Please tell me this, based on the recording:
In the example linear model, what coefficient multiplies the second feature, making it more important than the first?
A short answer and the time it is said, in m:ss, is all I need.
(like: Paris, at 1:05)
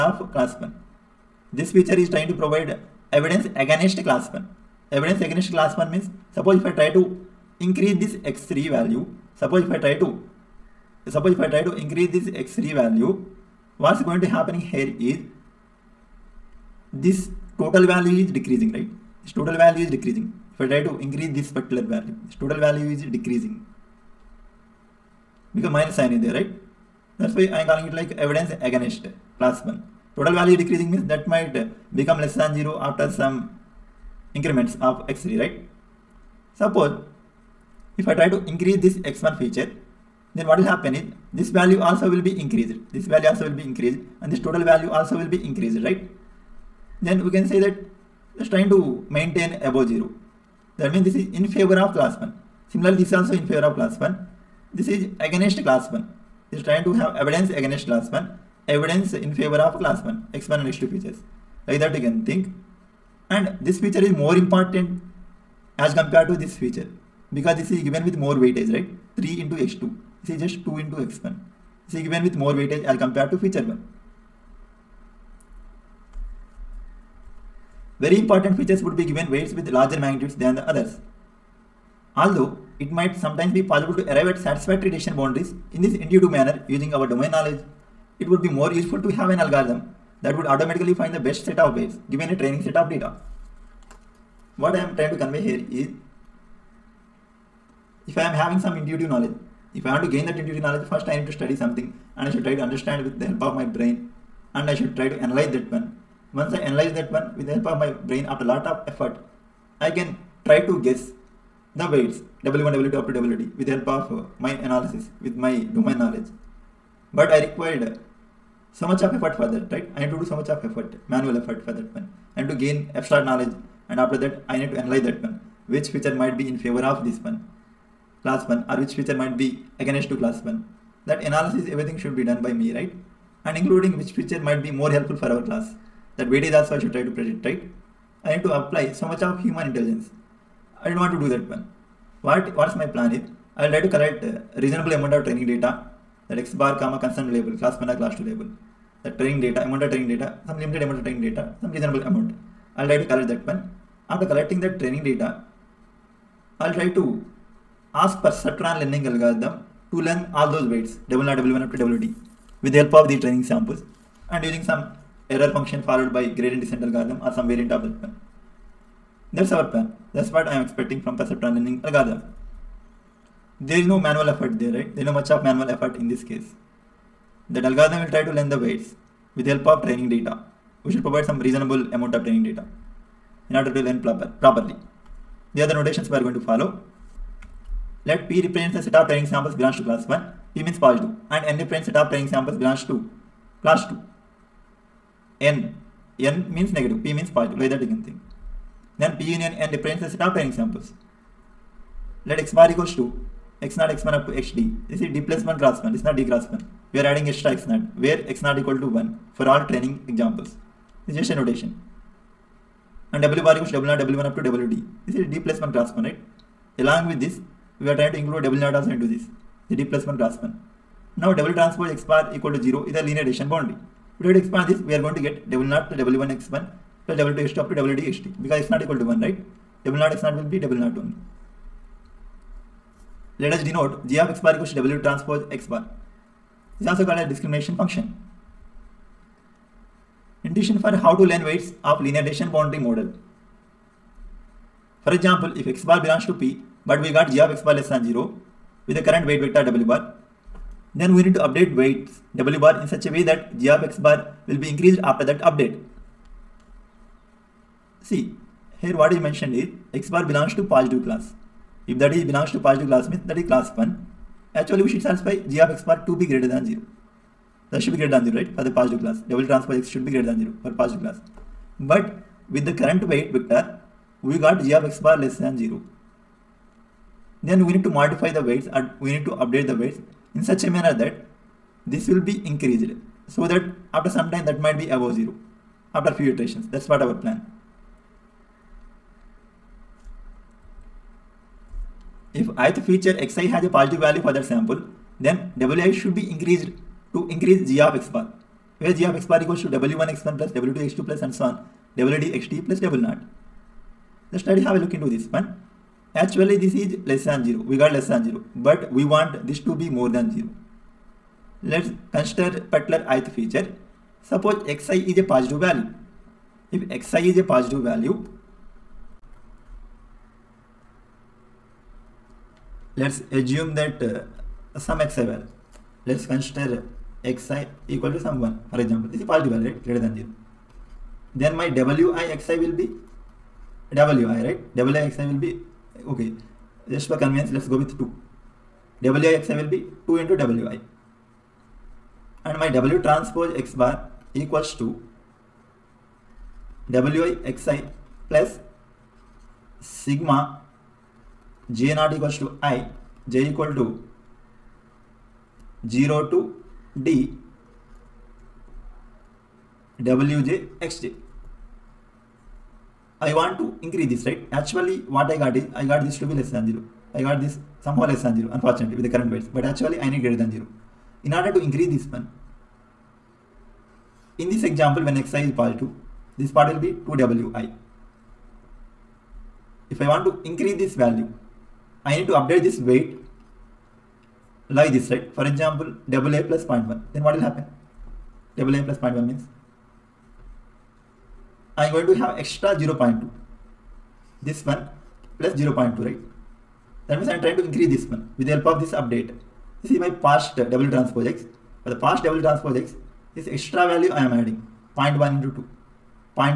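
3, at 1:09.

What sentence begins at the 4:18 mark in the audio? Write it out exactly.
See, here what is mentioned is x bar belongs to positive class.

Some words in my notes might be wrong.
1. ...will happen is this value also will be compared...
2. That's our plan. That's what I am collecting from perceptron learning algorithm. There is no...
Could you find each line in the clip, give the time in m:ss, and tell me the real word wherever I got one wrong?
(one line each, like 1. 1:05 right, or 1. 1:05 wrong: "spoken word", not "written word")
1. 0:40 wrong: "increased", not "compared"
2. 2:49 wrong: "expecting", not "collecting".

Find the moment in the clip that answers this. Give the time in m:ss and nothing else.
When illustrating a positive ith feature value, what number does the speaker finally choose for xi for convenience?
5:37.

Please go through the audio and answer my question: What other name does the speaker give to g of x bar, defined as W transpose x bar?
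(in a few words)
Discrimination function.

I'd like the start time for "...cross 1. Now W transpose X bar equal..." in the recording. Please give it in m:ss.
3:40.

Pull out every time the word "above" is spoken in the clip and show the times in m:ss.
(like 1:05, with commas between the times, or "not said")
0:49, 4:44.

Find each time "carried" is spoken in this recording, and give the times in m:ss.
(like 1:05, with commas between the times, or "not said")
not said.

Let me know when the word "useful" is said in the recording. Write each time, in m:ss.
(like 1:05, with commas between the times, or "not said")
1:28.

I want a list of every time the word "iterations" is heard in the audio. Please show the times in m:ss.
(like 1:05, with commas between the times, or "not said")
4:46.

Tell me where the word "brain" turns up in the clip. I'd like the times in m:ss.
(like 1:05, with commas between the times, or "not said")
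1:43, 1:47.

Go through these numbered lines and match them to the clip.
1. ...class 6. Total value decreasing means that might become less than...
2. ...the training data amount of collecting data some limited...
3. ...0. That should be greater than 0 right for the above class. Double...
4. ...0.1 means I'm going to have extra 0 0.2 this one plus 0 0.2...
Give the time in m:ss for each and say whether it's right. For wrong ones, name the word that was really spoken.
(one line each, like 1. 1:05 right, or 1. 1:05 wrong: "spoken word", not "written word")
1. 0:29 wrong: "1", not "6"
2. 2:29 wrong: "training", not "collecting"
3. 4:26 wrong: "positive", not "above"
4. 6:29 right.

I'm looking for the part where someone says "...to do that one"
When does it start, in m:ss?
2:21.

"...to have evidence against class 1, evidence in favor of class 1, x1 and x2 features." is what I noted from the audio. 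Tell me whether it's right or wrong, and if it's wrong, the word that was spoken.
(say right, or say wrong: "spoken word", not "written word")
right.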